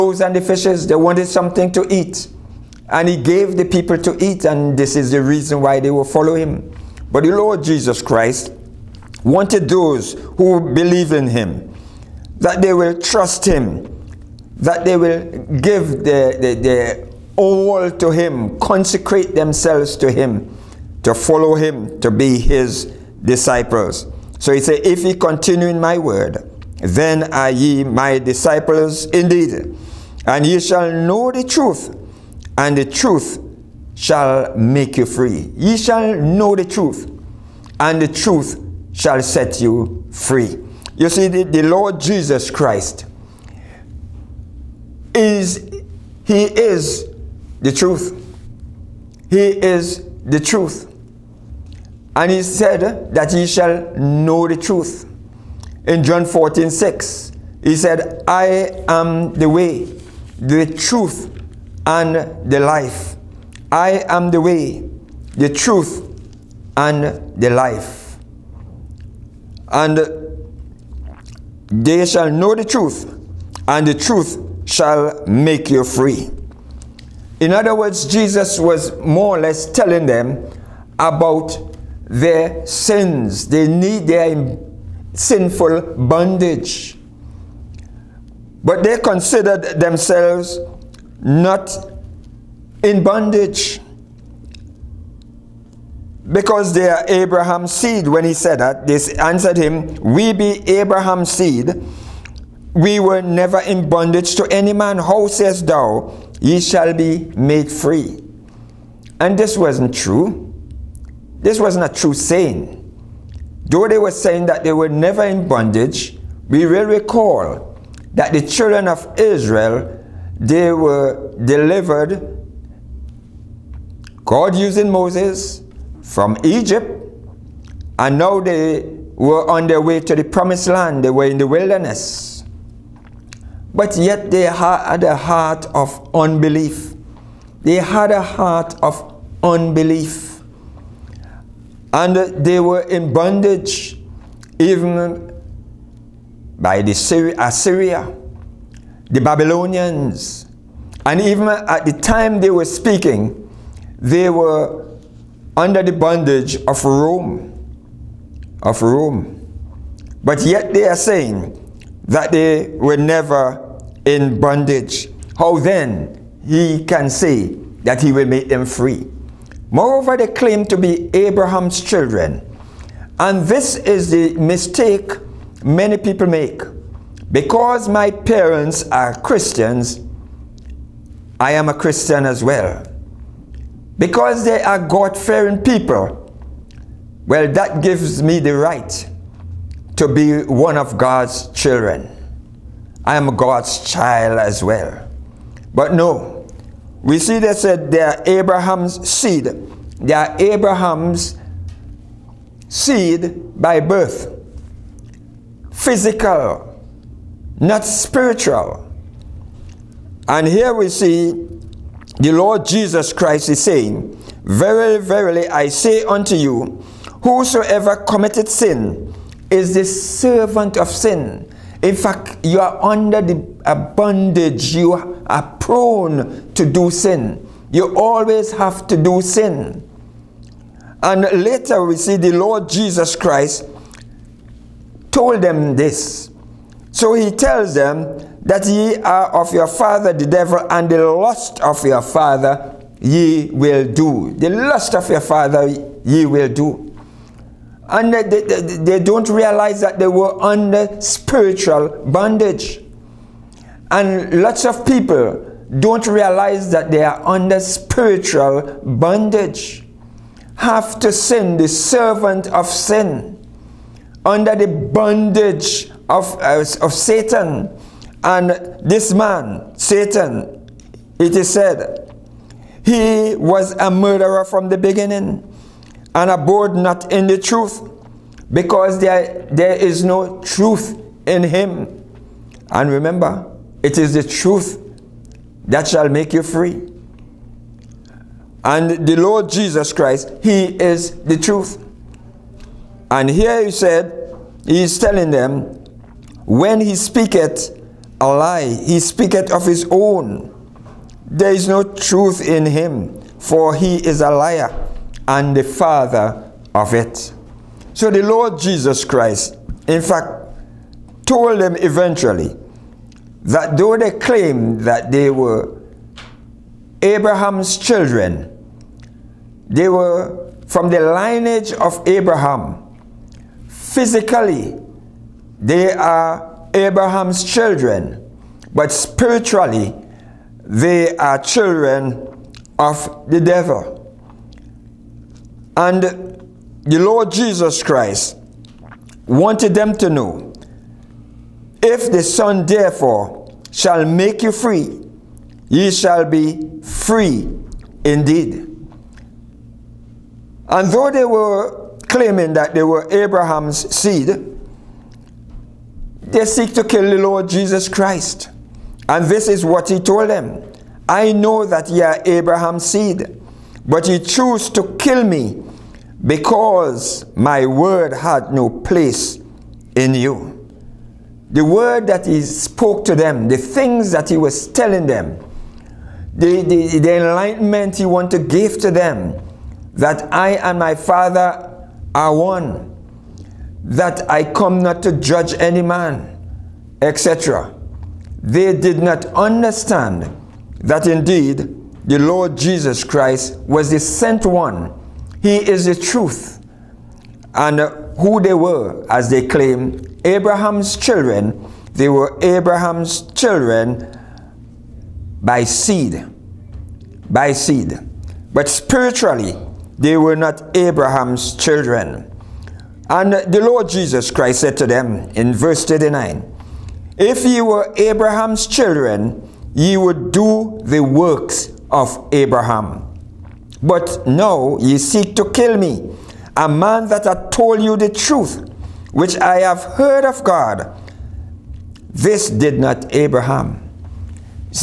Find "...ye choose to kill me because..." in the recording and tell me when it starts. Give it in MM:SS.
06:04.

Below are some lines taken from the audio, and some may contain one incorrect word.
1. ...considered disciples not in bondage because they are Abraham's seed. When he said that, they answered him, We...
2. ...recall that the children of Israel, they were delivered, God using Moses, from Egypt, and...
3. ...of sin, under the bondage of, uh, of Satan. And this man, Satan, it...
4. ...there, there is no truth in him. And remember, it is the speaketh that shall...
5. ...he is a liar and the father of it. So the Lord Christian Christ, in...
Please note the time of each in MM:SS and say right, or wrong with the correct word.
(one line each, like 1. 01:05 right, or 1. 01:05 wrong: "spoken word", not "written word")
1. 01:28 wrong: "themselves", not "disciples"
2. 01:56 right
3. 04:22 right
4. 04:38 wrong: "truth", not "speaketh"
5. 05:03 wrong: "Jesus", not "Christian".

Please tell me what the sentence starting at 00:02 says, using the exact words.
And he gave the people to eat, and this is the reason why they will follow him.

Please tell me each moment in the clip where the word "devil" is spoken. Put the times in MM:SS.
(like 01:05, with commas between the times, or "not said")
04:00, 05:33.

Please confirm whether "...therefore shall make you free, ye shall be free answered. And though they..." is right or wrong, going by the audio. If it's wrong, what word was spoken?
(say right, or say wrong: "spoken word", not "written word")
wrong: "indeed", not "answered".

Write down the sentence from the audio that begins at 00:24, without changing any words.
So he said, if ye continue in my word, then are ye my disciples indeed.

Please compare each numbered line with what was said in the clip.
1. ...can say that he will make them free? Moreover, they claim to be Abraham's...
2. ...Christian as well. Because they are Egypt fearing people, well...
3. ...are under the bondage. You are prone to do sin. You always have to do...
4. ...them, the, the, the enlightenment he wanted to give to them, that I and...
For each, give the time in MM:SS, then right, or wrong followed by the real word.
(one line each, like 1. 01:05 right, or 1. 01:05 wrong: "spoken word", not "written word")
1. 02:46 right
2. 03:01 wrong: "God", not "Egypt"
3. 03:42 right
4. 06:15 right.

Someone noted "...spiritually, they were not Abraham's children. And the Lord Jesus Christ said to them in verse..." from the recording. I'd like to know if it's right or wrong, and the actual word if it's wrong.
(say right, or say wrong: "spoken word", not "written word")
right.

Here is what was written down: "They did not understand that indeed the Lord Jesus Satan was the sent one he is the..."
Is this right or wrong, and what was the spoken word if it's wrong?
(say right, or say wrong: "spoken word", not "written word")
wrong: "Christ", not "Satan".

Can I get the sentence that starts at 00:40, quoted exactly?
You see, the, the Lord Jesus Christ is, he is the truth.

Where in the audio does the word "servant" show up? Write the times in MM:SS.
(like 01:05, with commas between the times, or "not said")
03:39, 04:21.